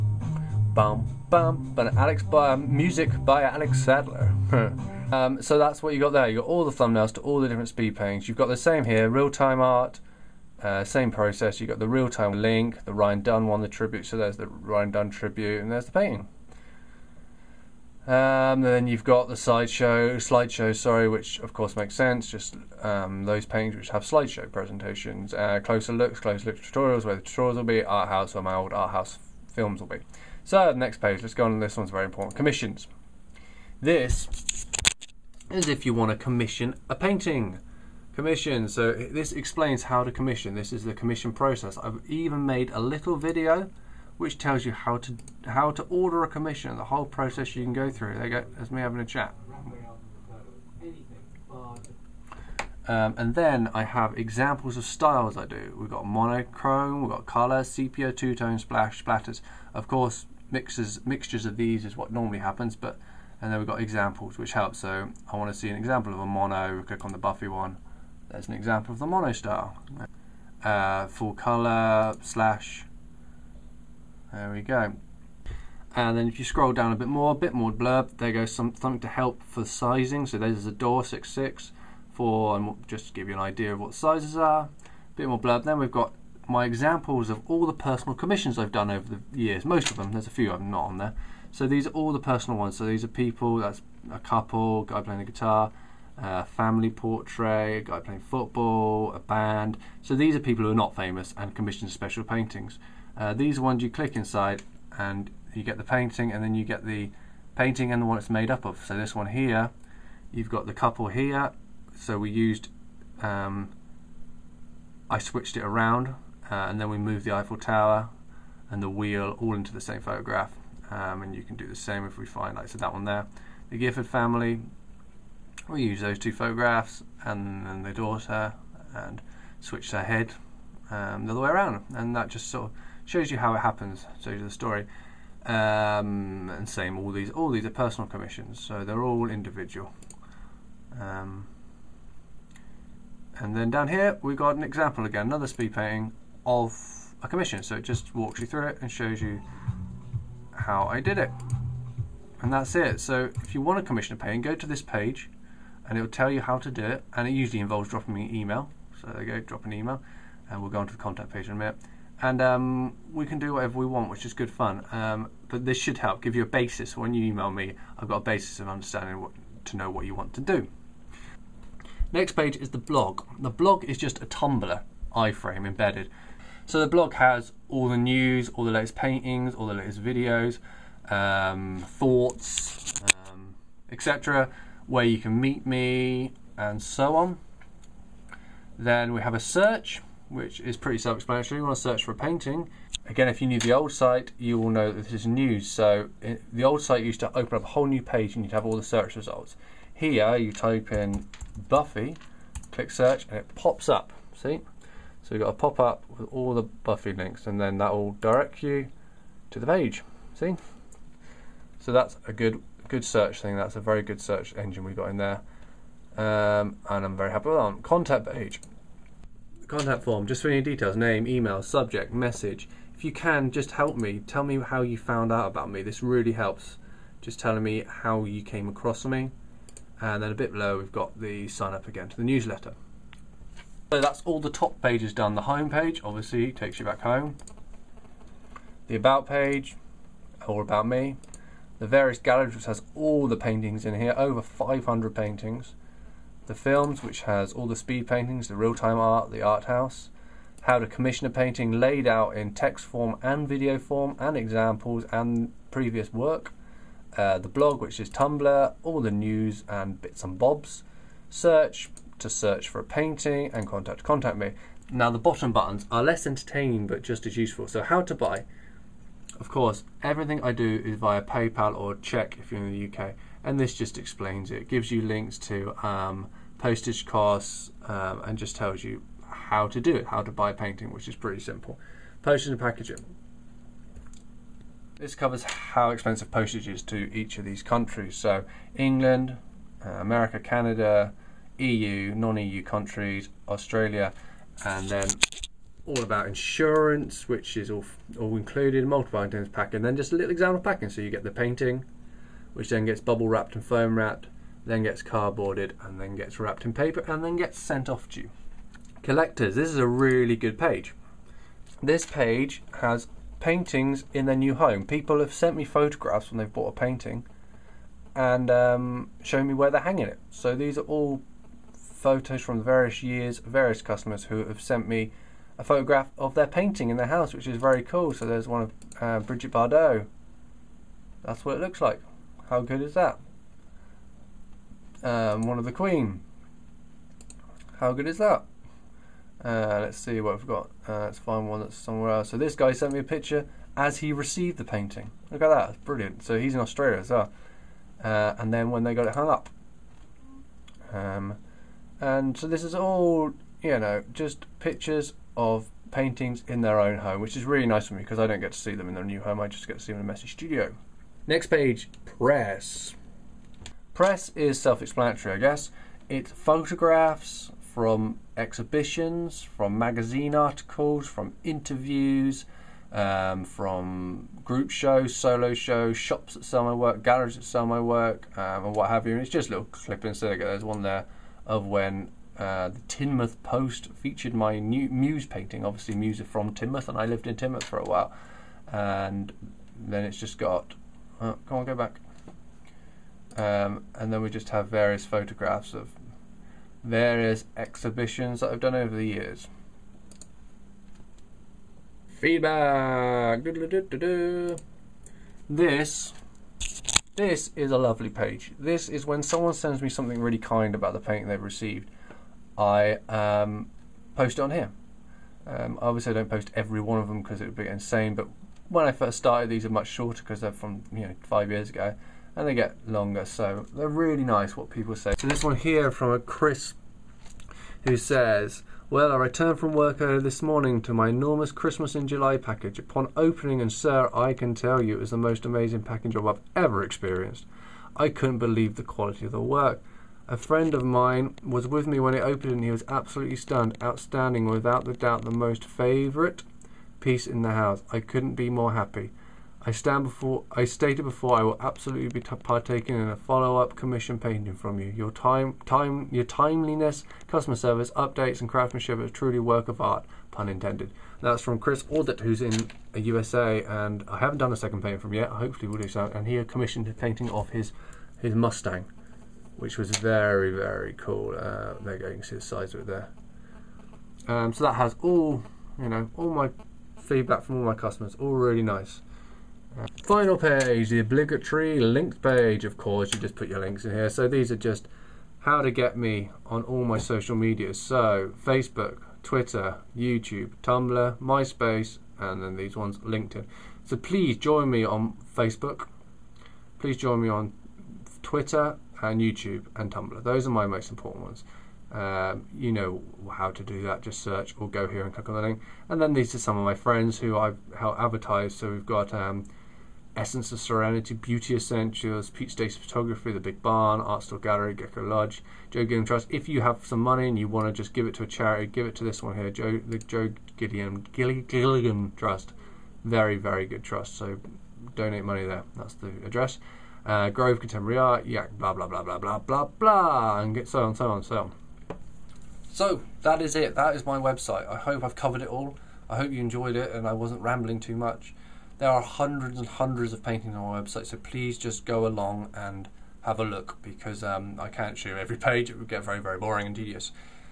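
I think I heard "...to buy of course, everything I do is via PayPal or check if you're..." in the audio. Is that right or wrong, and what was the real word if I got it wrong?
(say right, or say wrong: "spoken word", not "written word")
right.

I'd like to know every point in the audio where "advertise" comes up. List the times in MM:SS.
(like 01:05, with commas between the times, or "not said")
08:27.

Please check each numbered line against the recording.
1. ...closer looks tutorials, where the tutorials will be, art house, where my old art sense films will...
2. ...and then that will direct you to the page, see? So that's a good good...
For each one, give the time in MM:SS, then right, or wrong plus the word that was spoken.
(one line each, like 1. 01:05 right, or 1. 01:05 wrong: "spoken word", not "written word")
1. 00:26 wrong: "house", not "sense"
2. 03:27 right.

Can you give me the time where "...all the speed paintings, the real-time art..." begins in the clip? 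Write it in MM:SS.
04:07.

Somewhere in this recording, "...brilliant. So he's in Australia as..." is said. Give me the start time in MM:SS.
05:45.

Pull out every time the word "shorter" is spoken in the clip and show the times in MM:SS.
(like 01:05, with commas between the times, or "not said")
06:59.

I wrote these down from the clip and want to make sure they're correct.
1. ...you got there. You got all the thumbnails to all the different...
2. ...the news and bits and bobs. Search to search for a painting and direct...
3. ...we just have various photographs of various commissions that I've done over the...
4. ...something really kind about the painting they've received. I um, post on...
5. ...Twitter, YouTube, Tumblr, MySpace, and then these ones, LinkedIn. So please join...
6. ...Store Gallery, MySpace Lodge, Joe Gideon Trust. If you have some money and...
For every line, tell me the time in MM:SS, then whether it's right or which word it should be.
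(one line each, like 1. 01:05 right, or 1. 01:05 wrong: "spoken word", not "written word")
1. 00:05 right
2. 04:19 wrong: "contact", not "direct"
3. 06:34 wrong: "exhibitions", not "commissions"
4. 06:49 right
5. 08:09 right
6. 08:34 wrong: "Gecko", not "MySpace".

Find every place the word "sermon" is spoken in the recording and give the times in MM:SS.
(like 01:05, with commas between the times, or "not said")
not said.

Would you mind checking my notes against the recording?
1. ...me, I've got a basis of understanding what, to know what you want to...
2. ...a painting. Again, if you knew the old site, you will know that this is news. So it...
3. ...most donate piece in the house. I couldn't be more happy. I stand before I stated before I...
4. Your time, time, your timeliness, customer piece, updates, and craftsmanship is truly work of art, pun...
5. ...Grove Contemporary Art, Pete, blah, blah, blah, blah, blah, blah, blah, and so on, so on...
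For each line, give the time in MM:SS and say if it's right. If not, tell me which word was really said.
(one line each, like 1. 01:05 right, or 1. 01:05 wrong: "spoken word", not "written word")
1. 02:47 right
2. 03:12 right
3. 07:25 wrong: "favourite", not "donate"
4. 07:34 wrong: "service", not "piece"
5. 08:47 wrong: "Yak", not "Pete".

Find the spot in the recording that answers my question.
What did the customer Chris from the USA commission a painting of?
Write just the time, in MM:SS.
07:48.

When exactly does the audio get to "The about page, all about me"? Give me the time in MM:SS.
03:58.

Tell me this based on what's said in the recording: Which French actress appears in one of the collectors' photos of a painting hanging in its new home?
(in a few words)
Brigitte Bardot.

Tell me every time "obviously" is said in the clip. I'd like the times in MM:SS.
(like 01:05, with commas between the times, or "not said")
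03:56, 06:25.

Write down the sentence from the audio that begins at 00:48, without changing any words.
There go, that's me having a chat.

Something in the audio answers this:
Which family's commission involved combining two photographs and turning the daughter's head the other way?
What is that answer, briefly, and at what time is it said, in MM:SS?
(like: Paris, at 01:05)
The Gifford family, at 02:03.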